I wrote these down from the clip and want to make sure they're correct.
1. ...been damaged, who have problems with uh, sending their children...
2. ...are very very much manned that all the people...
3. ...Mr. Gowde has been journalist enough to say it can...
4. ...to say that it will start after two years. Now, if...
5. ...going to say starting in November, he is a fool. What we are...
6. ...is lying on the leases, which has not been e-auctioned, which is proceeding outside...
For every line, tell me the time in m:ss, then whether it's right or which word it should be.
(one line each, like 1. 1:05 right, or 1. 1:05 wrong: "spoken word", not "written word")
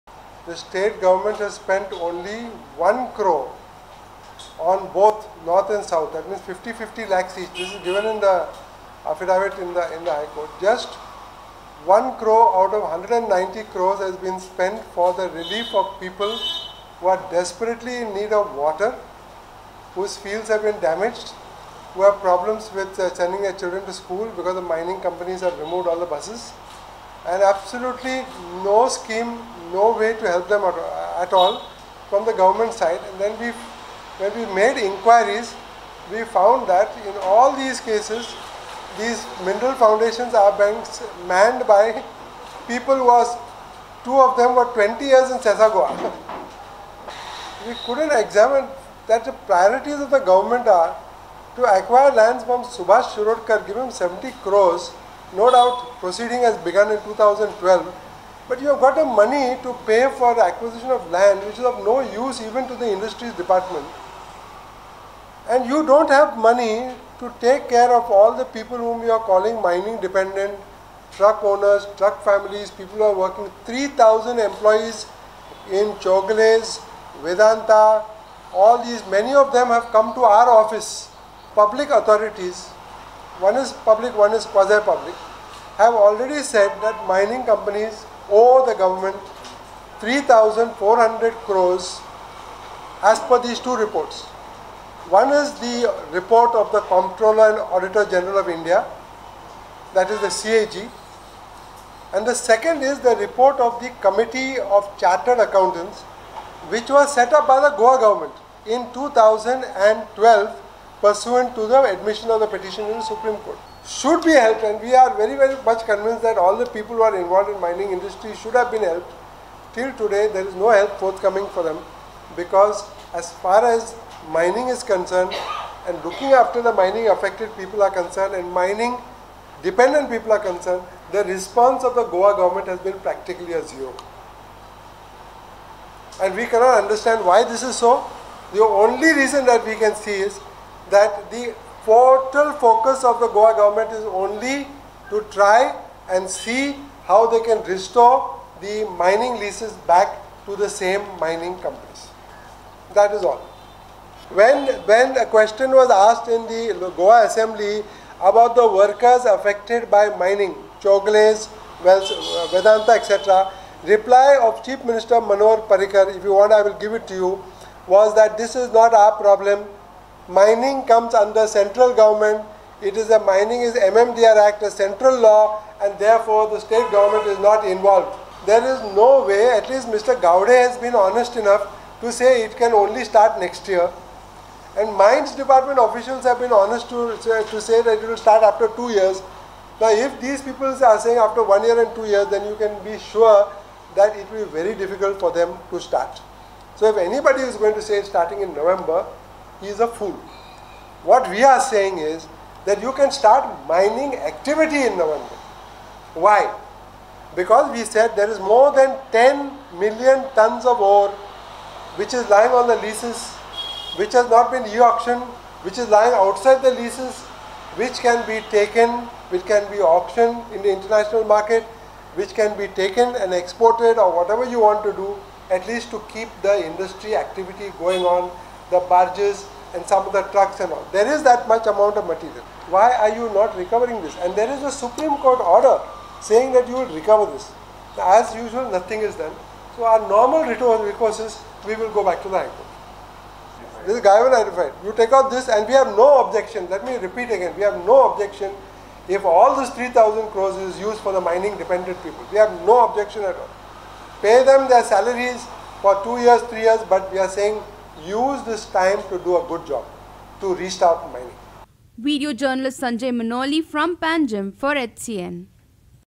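1. 0:20 right
2. 1:54 wrong: "convinced", not "manned"
3. 2:59 wrong: "honest", not "journalist"
4. 3:07 right
5. 3:17 right
6. 3:32 wrong: "lying", not "proceeding".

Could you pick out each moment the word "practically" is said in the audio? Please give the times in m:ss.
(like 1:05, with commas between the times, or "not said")
2:12.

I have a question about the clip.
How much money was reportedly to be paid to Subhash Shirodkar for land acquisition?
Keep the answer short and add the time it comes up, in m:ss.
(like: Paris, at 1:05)
70 crores, at 0:53.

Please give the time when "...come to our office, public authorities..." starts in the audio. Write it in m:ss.
1:19.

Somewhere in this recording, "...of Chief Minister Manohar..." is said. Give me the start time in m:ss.
2:44.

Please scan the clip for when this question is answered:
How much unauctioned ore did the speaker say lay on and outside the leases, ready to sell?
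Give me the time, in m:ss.
3:28.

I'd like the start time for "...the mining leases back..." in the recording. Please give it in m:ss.
2:28.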